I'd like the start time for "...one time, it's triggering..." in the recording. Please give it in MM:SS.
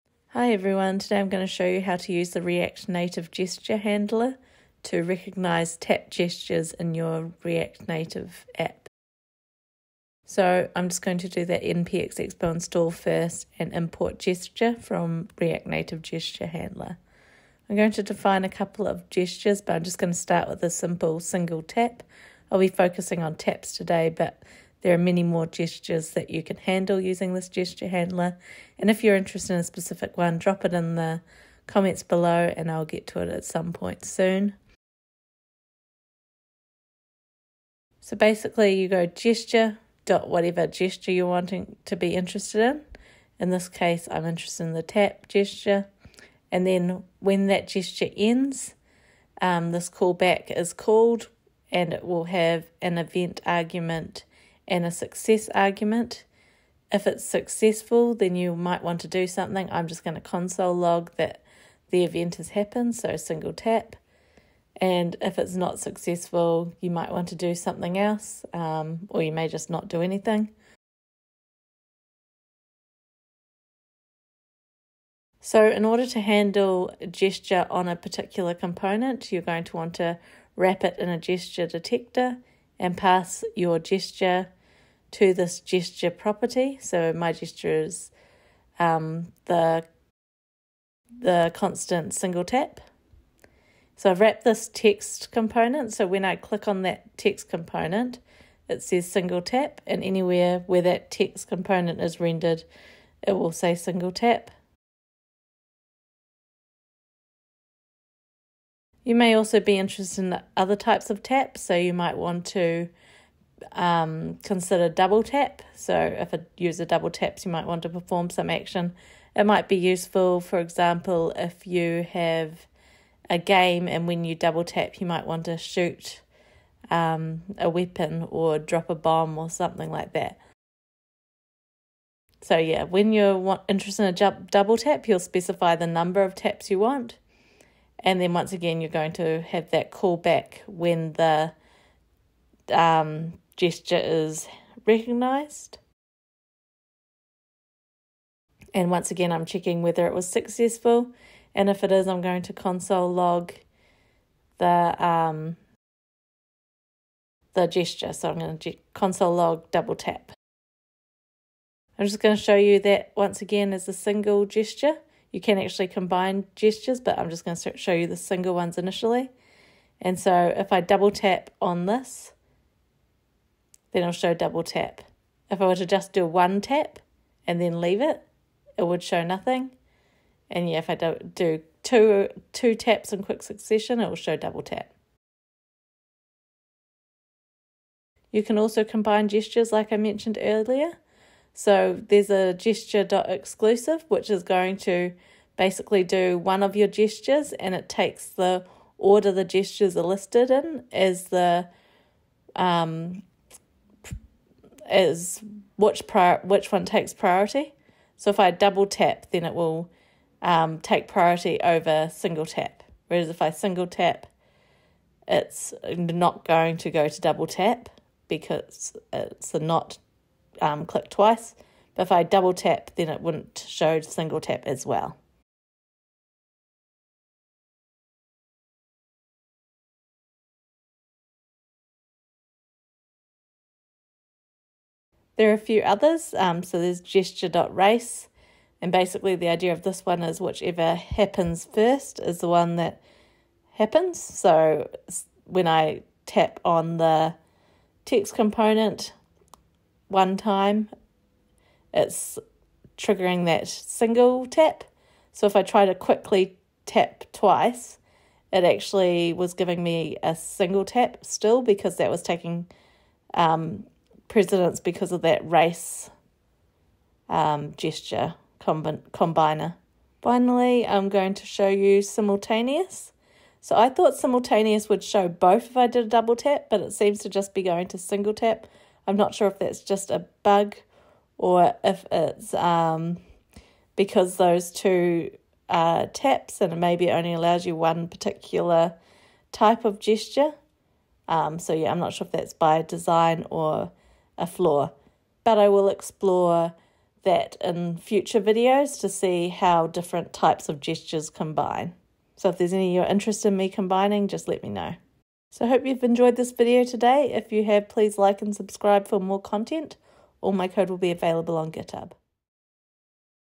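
04:10.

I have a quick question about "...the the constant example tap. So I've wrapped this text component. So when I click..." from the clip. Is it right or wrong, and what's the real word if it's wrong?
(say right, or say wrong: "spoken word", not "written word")
wrong: "single", not "example".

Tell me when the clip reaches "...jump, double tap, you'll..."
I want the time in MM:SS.
02:14.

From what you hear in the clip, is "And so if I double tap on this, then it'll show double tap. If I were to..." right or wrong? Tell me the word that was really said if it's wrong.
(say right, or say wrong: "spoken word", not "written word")
right.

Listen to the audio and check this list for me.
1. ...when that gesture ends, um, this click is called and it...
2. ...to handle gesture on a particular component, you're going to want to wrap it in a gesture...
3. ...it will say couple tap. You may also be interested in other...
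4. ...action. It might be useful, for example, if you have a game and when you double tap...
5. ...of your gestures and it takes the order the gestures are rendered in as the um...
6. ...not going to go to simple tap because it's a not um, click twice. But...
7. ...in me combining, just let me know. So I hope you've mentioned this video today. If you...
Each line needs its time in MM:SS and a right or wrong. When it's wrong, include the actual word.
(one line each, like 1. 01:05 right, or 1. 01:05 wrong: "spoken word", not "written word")
1. 00:47 wrong: "callback", not "click"
2. 01:16 right
3. 01:43 wrong: "single", not "couple"
4. 01:58 right
5. 03:16 wrong: "listed", not "rendered"
6. 03:35 wrong: "double", not "simple"
7. 05:03 wrong: "enjoyed", not "mentioned".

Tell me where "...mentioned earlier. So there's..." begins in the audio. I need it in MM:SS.
03:09.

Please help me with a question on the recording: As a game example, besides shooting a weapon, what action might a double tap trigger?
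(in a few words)
drop a bomb.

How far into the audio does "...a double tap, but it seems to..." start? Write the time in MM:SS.
04:36.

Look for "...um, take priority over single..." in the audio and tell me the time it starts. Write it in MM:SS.
03:30.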